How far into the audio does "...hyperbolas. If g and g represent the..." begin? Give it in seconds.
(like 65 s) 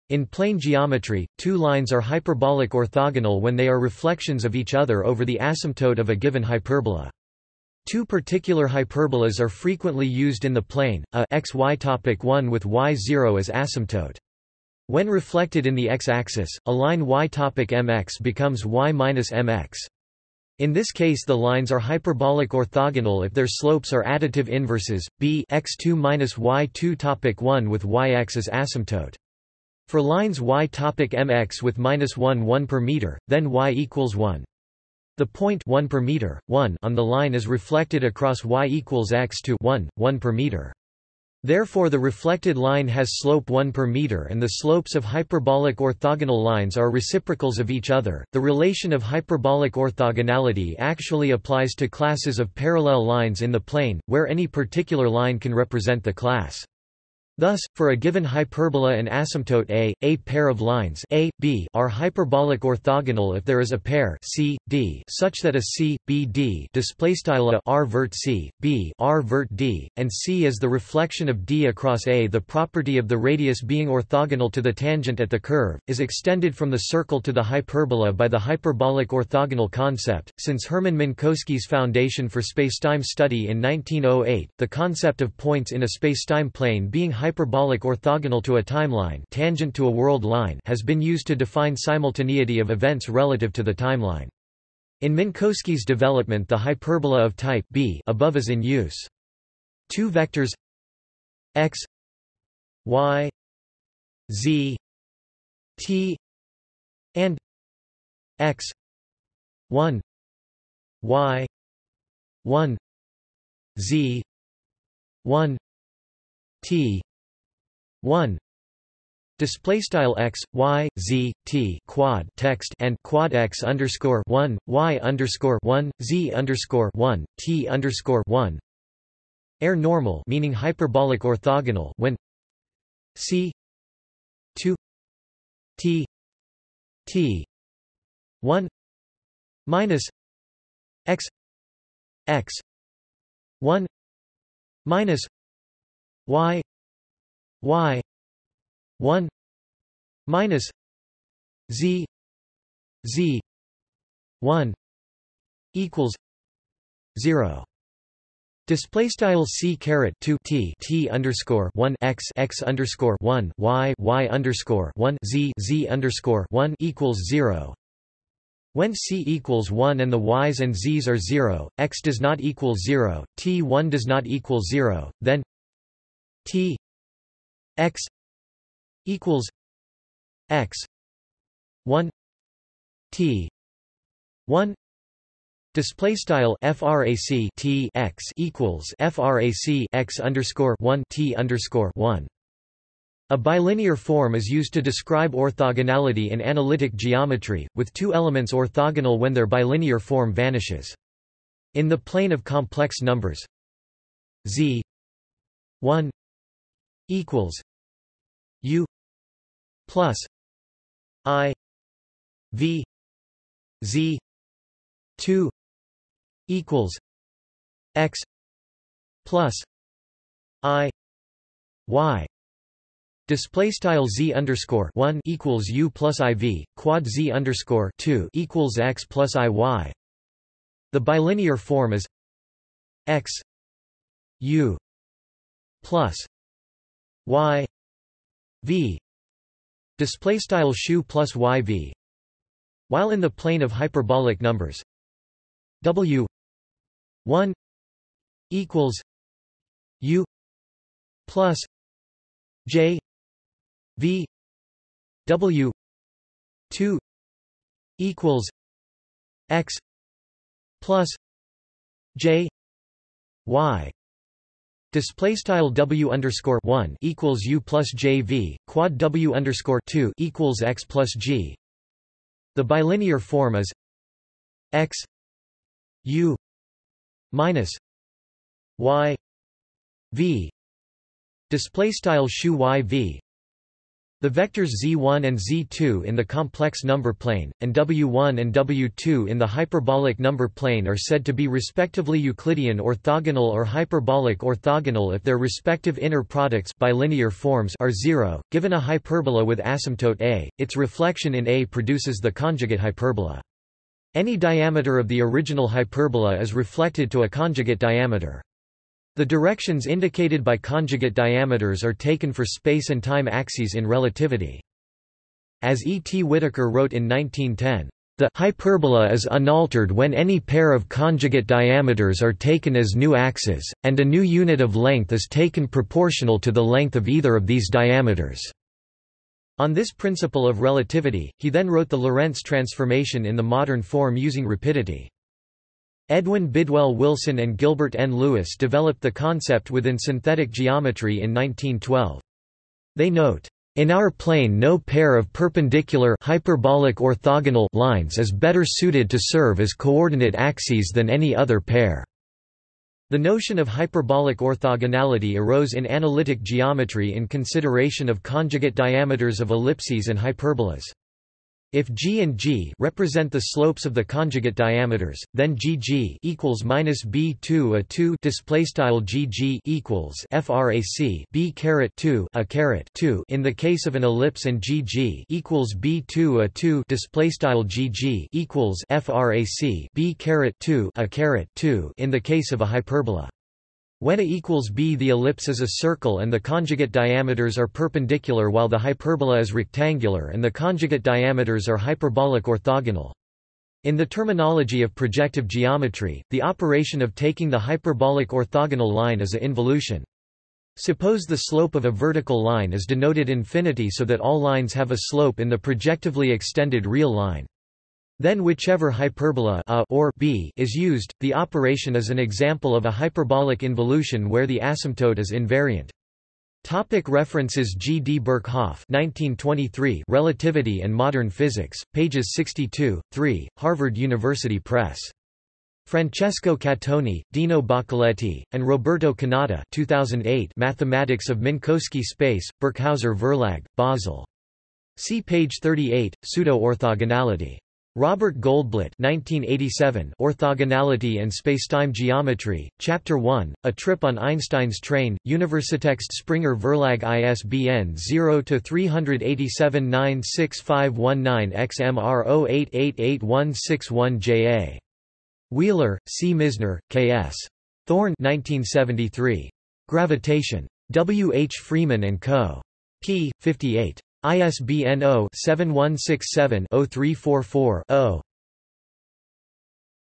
360 s.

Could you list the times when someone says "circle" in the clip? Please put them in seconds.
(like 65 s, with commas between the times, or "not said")
76 s, 385 s.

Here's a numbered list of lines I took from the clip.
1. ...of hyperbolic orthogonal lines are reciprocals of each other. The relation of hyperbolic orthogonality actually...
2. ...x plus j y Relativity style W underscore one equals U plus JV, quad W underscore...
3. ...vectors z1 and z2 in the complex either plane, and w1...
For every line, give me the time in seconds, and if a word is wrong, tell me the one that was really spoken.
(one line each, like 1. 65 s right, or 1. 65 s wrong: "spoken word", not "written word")
1. 44 s right
2. 259 s wrong: "Display", not "Relativity"
3. 284 s wrong: "number", not "either".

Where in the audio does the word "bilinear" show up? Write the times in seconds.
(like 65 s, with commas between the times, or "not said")
193 s, 199 s, 230 s, 272 s, 296 s.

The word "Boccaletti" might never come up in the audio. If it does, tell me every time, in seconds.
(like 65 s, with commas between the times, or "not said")
427 s.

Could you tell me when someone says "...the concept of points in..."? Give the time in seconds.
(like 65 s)
84 s.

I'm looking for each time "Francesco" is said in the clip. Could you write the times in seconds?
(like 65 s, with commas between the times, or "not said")
425 s.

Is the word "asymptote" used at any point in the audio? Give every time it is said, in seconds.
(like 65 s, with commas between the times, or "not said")
5 s, 13 s, 28 s, 59 s, 299 s, 414 s.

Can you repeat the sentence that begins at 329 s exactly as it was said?
On this principle of relativity, he then wrote the Lorentz transformation in the modern form using rapidity.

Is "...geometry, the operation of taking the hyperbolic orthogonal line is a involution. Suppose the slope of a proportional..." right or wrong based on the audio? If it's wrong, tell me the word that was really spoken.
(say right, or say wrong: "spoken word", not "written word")
wrong: "vertical", not "proportional".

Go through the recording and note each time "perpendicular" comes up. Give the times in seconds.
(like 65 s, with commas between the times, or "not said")
345 s, 387 s.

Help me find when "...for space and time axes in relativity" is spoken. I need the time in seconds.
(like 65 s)
312 s.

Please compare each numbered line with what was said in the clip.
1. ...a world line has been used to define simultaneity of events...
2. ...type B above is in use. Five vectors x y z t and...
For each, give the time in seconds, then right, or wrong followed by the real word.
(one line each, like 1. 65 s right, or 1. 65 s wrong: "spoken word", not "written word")
1. 89 s right
2. 97 s wrong: "Two", not "Five".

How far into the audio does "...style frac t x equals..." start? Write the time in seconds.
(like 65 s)
186 s.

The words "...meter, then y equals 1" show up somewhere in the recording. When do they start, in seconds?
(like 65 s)
32 s.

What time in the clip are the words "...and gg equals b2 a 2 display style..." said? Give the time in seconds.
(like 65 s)
374 s.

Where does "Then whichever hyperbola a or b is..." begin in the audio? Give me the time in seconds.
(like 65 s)
408 s.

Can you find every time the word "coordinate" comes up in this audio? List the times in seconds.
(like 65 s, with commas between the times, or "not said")
349 s.